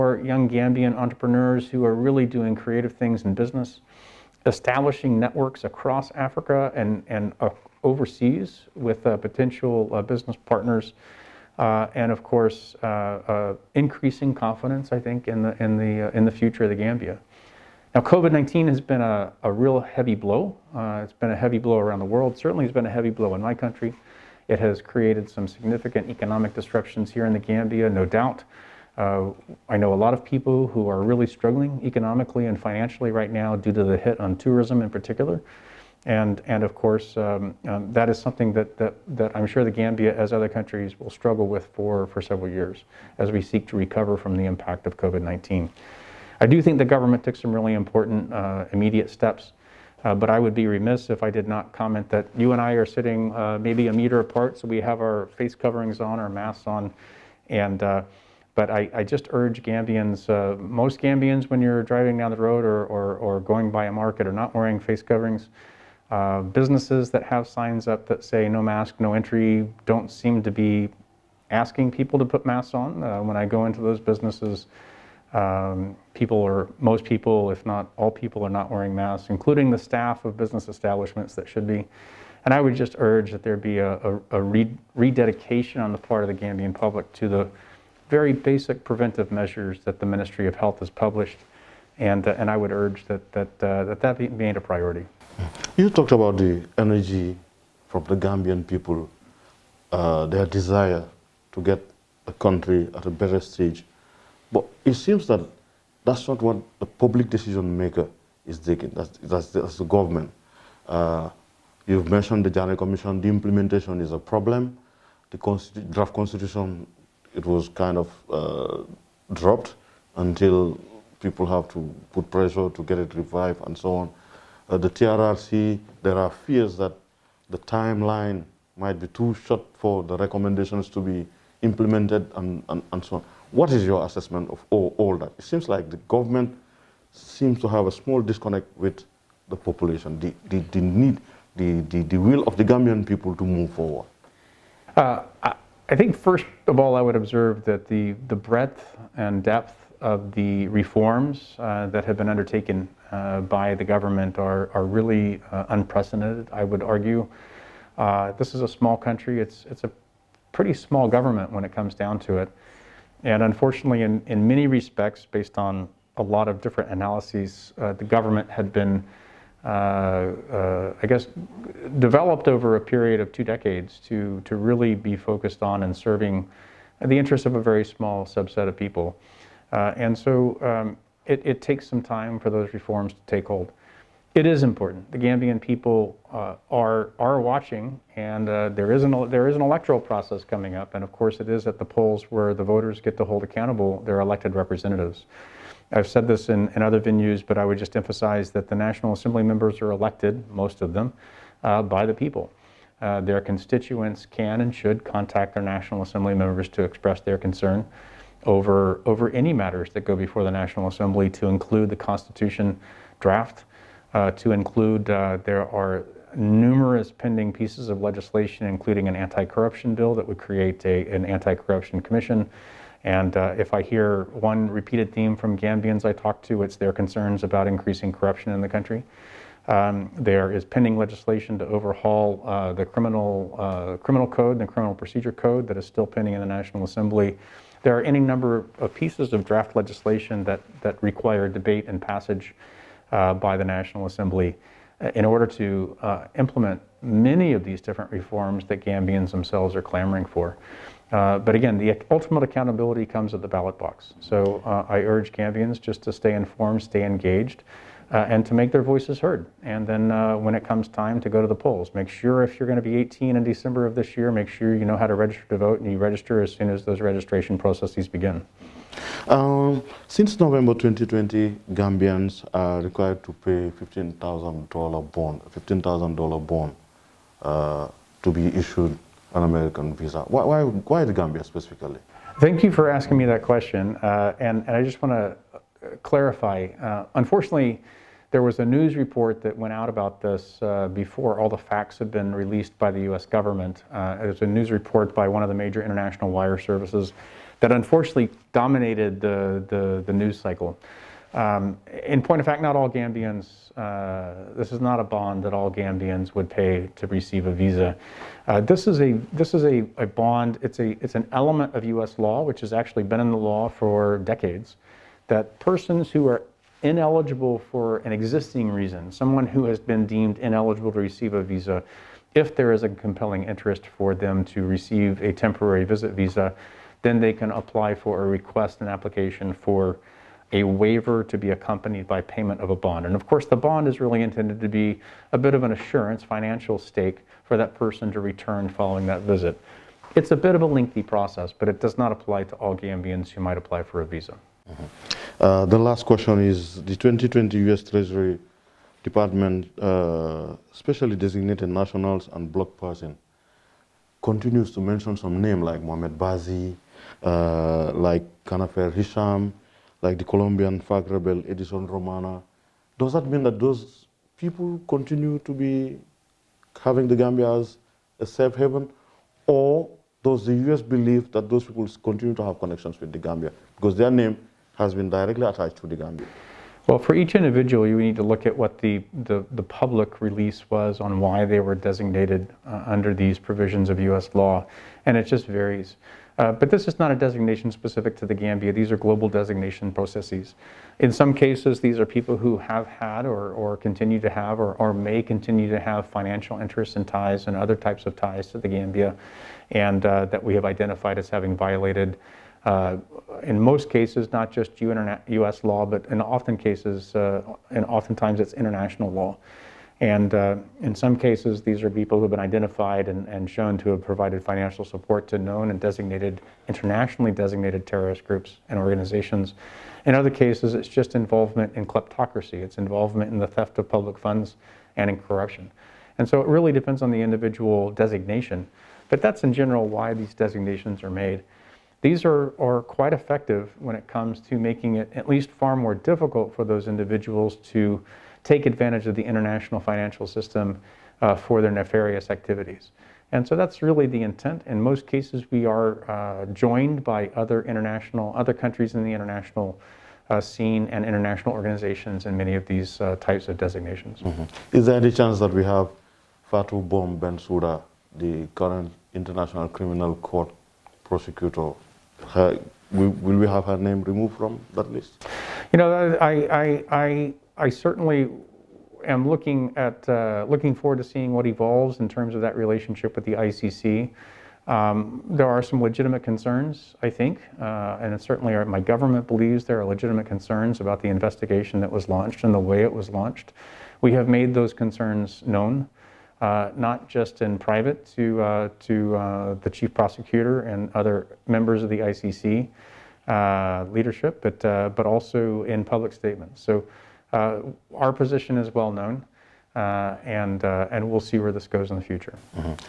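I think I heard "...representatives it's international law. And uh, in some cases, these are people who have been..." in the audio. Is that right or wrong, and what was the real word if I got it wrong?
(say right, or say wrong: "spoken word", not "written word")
wrong: "oftentimes", not "representatives".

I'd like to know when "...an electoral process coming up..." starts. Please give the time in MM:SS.
03:09.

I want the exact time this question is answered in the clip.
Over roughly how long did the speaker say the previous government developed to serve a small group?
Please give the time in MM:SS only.
02:53.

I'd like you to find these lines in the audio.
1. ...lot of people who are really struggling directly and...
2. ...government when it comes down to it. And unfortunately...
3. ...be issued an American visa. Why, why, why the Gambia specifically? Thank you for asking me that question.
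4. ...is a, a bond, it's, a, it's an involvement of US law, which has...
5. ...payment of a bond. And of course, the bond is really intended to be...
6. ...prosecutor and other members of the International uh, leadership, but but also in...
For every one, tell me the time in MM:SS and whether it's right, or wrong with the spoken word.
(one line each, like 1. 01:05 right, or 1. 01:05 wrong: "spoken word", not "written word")
1. 00:30 wrong: "economically", not "directly"
2. 02:41 right
3. 04:38 right
4. 05:09 wrong: "element", not "involvement"
5. 05:32 right
6. 08:09 wrong: "ICC", not "International".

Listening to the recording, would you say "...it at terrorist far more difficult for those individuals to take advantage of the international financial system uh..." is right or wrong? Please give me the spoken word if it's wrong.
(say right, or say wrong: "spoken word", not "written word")
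wrong: "least", not "terrorist".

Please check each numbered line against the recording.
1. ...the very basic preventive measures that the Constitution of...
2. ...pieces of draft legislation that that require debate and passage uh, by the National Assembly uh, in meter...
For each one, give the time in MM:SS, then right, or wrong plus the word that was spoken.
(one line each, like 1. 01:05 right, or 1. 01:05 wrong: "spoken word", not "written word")
1. 01:27 wrong: "Ministry", not "Constitution"
2. 03:58 wrong: "order", not "meter".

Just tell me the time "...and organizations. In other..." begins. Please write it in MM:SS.
06:58.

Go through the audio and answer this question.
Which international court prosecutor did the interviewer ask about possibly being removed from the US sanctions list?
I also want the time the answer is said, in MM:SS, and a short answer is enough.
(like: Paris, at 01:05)
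Fatou Bom Bensouda, at 07:36.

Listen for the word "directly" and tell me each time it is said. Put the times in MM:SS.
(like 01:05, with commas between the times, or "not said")
06:15.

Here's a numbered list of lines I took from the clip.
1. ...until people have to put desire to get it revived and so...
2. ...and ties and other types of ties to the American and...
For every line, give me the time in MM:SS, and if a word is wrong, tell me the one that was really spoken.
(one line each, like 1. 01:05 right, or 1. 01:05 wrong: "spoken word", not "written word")
1. 02:00 wrong: "pressure", not "desire"
2. 06:36 wrong: "Gambia", not "American".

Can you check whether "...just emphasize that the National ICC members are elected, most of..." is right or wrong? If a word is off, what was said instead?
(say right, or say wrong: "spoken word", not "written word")
wrong: "Assembly", not "ICC".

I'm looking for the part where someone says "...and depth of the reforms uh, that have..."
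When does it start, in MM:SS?
02:29.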